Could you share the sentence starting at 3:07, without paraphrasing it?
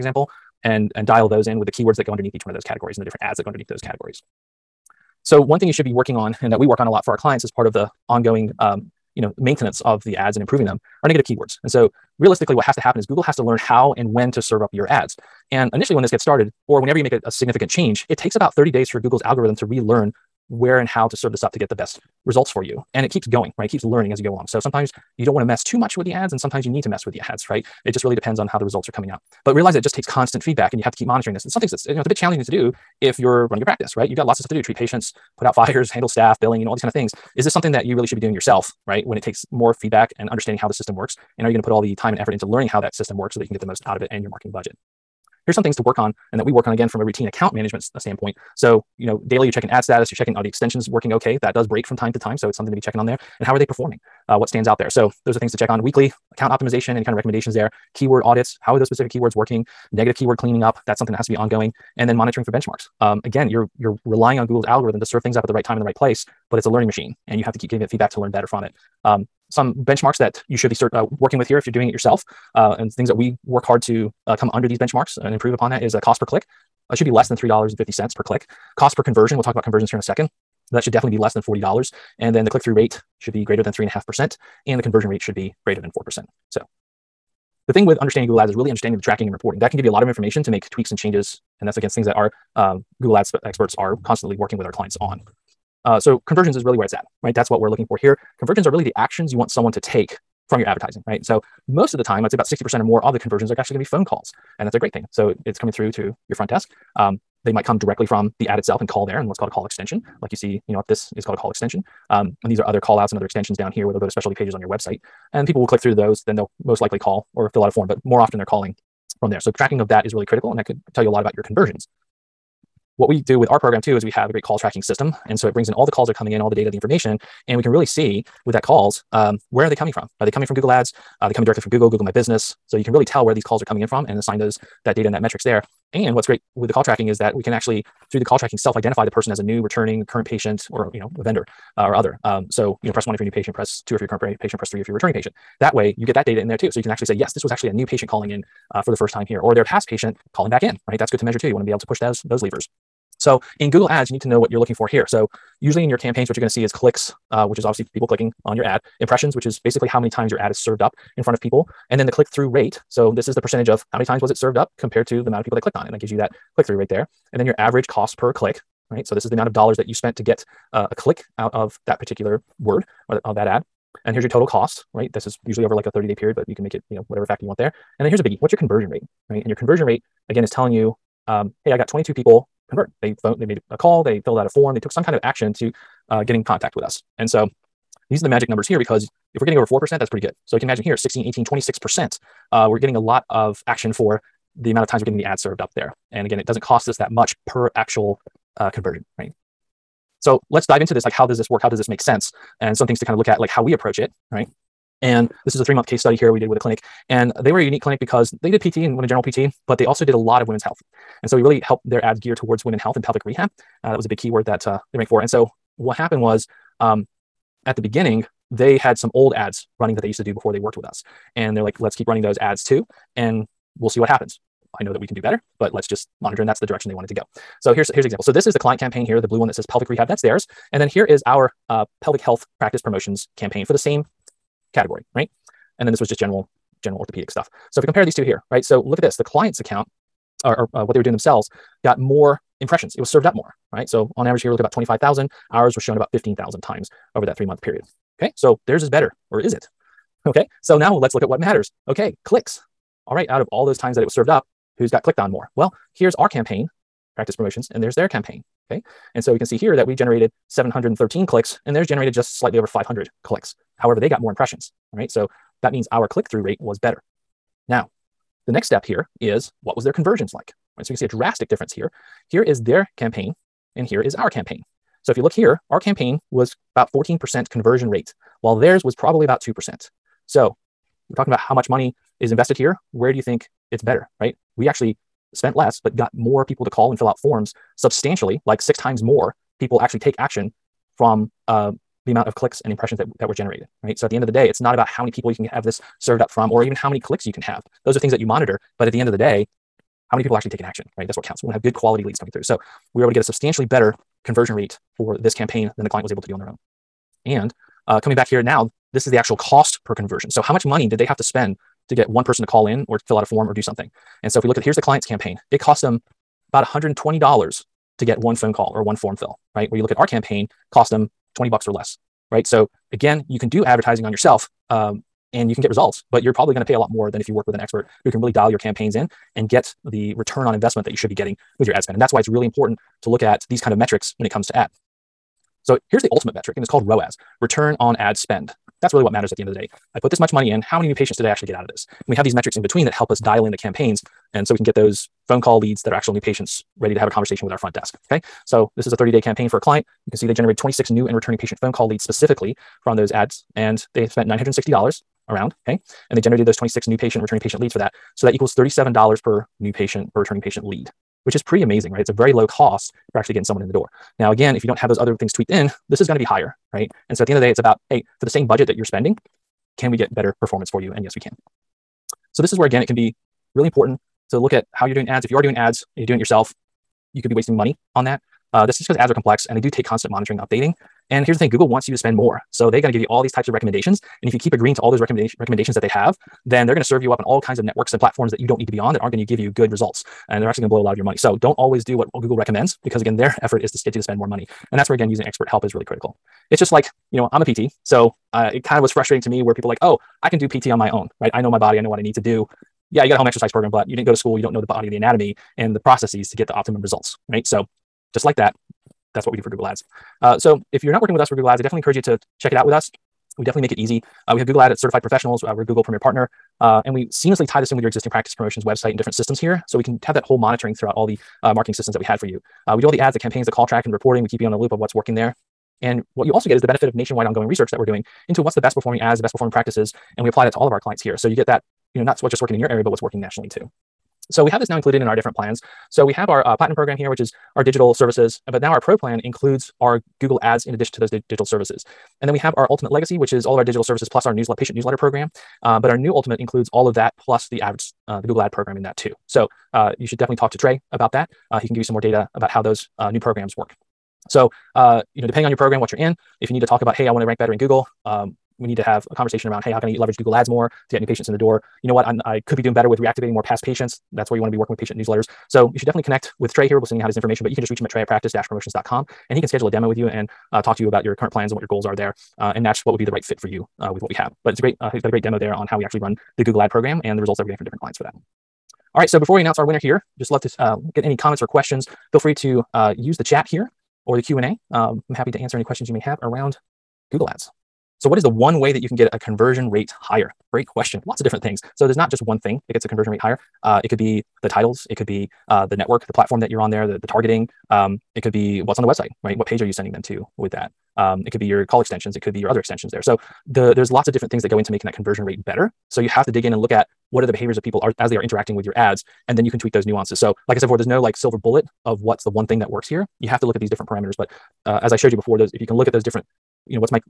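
And so these are the magic numbers here because if we're getting over 4%, that's pretty good.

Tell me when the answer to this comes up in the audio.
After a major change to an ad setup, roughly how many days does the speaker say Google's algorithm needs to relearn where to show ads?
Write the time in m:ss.
0:18.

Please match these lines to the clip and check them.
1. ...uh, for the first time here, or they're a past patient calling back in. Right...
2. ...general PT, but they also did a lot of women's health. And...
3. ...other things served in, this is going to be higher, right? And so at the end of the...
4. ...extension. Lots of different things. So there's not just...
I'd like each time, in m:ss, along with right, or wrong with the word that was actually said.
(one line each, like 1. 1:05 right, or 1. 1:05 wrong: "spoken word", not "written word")
1. 2:28 right
2. 3:29 right
3. 6:04 wrong: "tweaked", not "served"
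4. 8:10 wrong: "question", not "extension".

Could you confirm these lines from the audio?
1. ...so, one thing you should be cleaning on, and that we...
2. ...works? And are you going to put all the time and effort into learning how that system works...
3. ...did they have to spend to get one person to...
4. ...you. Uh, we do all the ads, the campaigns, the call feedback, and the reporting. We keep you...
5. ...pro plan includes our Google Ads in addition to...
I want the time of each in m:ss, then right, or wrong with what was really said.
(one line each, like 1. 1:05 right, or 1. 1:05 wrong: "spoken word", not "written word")
1. 0:05 wrong: "working", not "cleaning"
2. 0:40 right
3. 5:10 right
4. 7:02 wrong: "track", not "feedback"
5. 7:18 right.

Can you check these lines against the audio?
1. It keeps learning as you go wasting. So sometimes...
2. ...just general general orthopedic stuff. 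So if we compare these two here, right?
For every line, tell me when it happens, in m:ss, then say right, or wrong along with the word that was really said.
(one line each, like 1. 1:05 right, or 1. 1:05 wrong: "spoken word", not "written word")
1. 0:23 wrong: "along", not "wasting"
2. 3:56 right.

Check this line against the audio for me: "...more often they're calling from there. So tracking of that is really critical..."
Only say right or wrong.
right.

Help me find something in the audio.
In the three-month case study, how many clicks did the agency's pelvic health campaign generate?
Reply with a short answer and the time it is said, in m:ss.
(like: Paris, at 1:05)
713, at 4:20.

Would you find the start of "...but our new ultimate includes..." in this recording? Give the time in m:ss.
7:25.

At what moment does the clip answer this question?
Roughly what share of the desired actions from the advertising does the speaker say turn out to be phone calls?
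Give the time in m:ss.
1:42.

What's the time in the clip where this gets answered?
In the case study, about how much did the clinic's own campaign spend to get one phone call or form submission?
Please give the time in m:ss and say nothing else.
5:16.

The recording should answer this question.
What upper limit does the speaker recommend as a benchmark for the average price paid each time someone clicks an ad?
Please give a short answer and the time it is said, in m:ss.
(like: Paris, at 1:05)
$3.50, at 1:17.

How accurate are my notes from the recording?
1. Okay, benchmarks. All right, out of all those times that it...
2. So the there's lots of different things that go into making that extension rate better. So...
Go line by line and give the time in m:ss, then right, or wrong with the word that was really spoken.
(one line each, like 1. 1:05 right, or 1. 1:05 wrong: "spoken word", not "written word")
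1. 4:11 wrong: "clicks", not "benchmarks"
2. 8:23 wrong: "conversion", not "extension".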